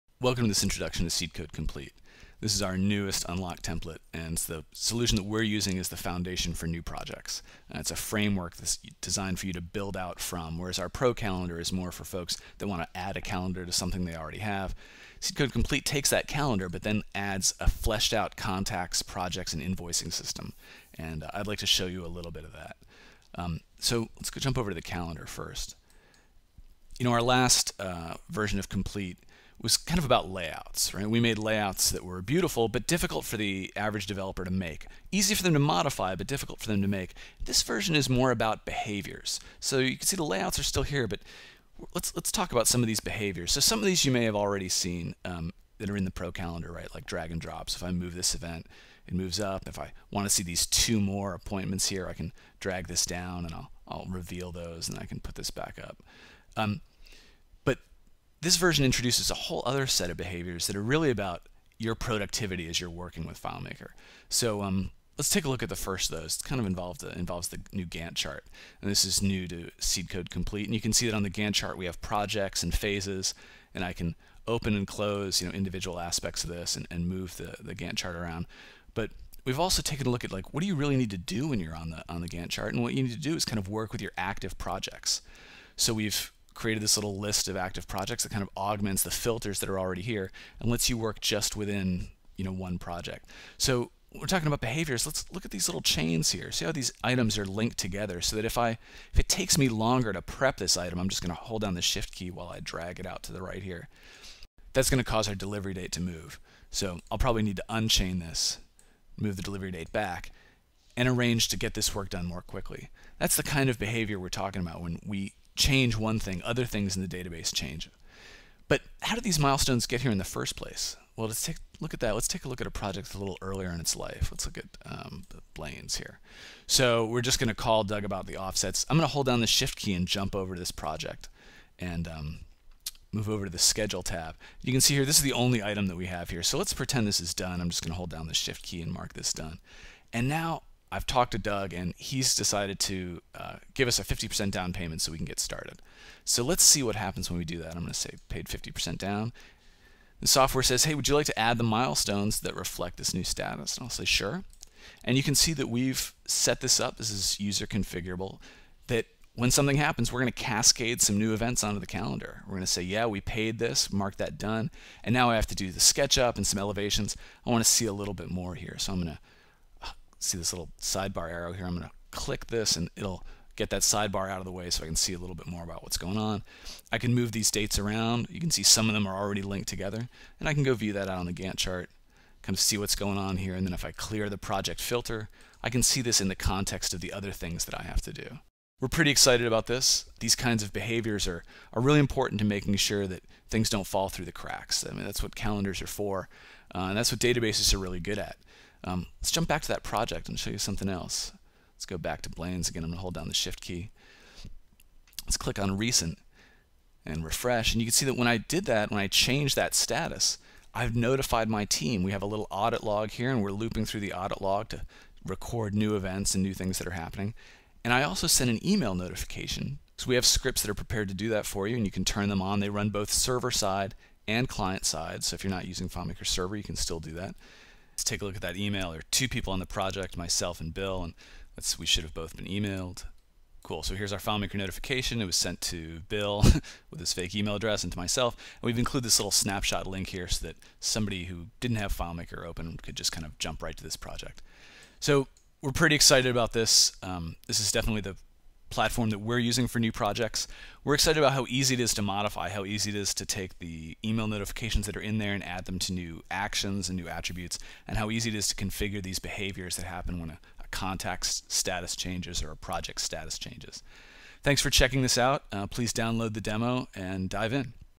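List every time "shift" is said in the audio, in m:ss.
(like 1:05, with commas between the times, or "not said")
1:41, 2:09, 2:18, 3:23.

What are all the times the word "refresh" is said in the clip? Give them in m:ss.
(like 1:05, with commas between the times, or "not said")
3:27.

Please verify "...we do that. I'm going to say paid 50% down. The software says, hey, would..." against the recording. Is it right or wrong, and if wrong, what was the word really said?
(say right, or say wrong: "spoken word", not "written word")
right.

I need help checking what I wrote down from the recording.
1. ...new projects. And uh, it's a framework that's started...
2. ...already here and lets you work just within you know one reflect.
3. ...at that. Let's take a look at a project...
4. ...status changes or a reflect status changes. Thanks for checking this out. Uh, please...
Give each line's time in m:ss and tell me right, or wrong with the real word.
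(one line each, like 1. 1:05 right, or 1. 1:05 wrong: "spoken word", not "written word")
1. 0:06 wrong: "designed", not "started"
2. 1:29 wrong: "project", not "reflect"
3. 2:01 right
4. 4:21 wrong: "project", not "reflect".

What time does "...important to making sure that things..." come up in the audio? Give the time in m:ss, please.
3:11.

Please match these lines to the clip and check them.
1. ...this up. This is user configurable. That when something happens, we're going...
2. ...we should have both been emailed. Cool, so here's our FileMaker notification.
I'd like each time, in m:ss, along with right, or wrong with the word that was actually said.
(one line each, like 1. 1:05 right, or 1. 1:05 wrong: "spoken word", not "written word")
1. 2:36 right
2. 3:51 right.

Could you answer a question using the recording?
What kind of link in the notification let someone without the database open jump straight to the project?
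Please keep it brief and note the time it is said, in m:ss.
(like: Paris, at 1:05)
snapshot link, at 3:59.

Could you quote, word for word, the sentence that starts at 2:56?
I can move these dates around.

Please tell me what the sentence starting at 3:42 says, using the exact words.
They run both server side and client side.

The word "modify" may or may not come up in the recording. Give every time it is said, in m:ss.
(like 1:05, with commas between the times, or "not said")
0:35, 4:12.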